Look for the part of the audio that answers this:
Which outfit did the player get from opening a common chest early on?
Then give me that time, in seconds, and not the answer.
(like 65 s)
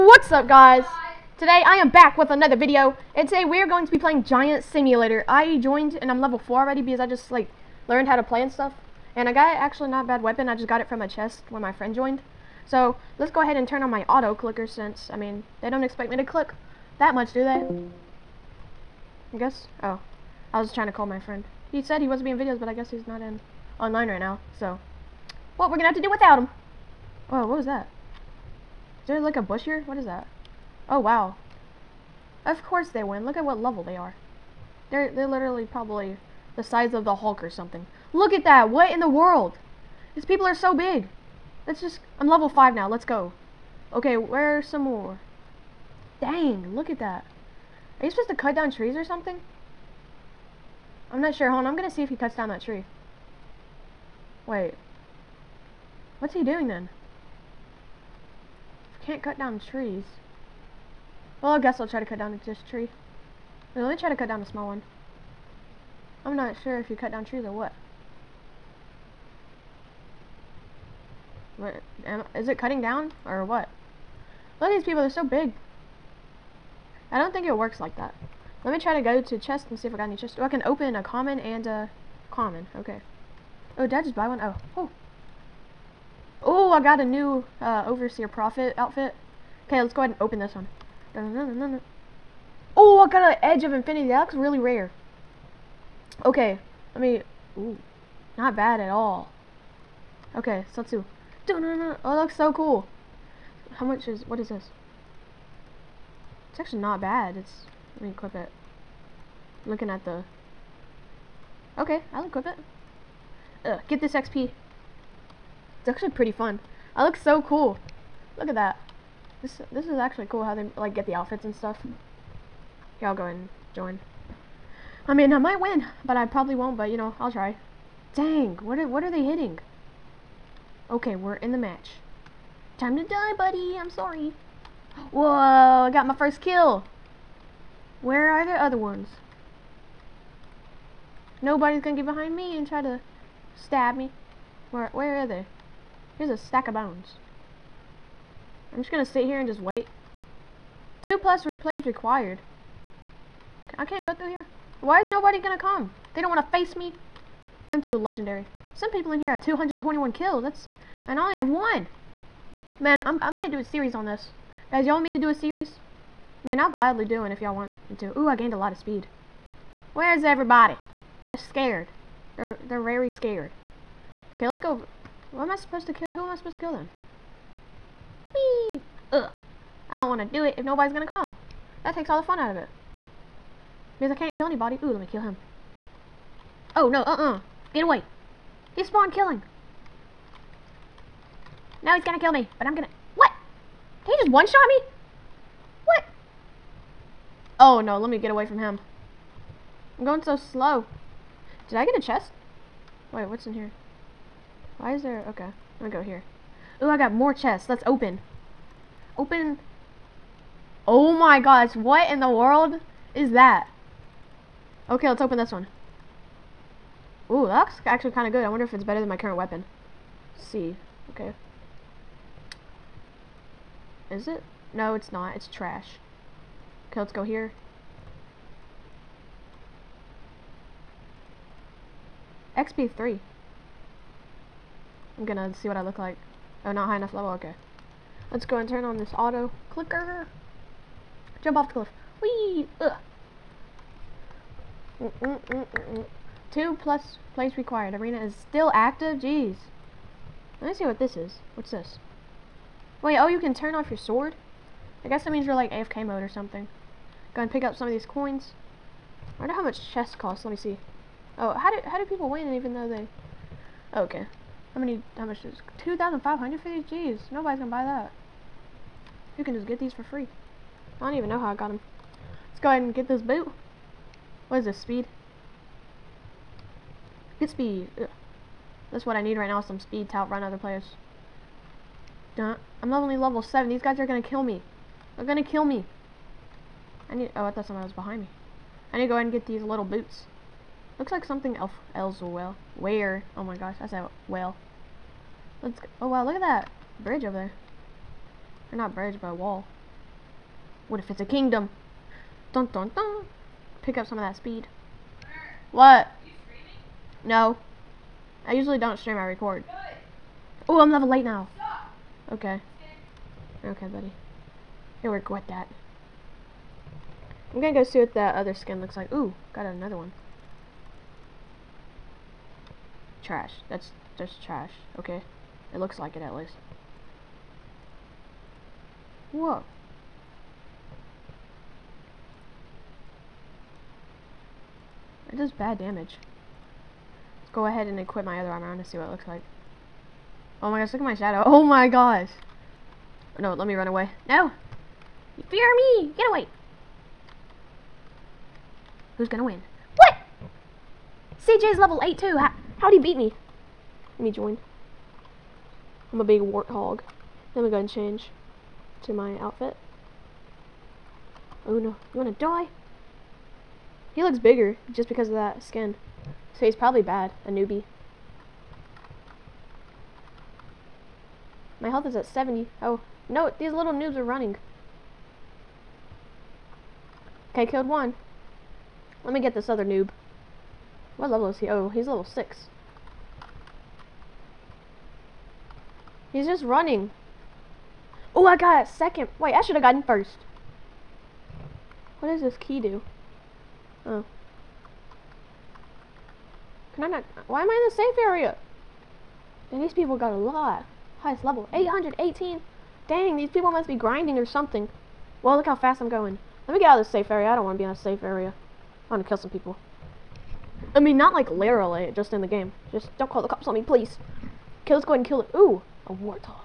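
87 s.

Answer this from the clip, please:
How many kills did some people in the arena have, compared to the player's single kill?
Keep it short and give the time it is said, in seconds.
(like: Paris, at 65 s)
221, at 159 s.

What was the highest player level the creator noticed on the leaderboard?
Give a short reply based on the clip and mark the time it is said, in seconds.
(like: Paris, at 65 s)
818, at 401 s.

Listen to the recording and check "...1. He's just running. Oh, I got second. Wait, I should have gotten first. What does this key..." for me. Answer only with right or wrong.
wrong.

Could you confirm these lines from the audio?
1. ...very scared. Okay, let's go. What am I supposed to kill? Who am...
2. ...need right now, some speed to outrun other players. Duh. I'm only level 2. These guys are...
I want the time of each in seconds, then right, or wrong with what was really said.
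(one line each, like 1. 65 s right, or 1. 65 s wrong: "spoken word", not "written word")
1. 172 s right
2. 279 s wrong: "7", not "2".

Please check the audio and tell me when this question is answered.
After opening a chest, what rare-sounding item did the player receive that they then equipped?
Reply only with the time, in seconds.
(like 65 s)
93 s.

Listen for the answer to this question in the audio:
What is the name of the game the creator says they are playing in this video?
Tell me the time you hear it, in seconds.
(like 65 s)
4 s.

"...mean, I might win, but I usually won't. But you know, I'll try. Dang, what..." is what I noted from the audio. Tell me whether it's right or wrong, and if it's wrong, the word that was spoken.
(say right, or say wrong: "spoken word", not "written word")
wrong: "probably", not "usually".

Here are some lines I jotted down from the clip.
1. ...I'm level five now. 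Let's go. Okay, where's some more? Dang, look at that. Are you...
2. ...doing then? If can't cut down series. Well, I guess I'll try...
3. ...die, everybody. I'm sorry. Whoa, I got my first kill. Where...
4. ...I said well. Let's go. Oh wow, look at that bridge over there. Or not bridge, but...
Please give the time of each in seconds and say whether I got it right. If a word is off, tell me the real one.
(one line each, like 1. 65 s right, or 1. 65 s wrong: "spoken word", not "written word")
1. 42 s right
2. 56 s wrong: "trees", not "series"
3. 133 s wrong: "buddy", not "everybody"
4. 293 s right.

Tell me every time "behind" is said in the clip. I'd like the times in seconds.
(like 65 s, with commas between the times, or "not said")
142 s, 287 s.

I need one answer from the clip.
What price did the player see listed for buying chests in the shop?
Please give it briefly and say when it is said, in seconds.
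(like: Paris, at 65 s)
2500, at 265 s.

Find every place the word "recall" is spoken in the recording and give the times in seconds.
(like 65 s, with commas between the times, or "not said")
not said.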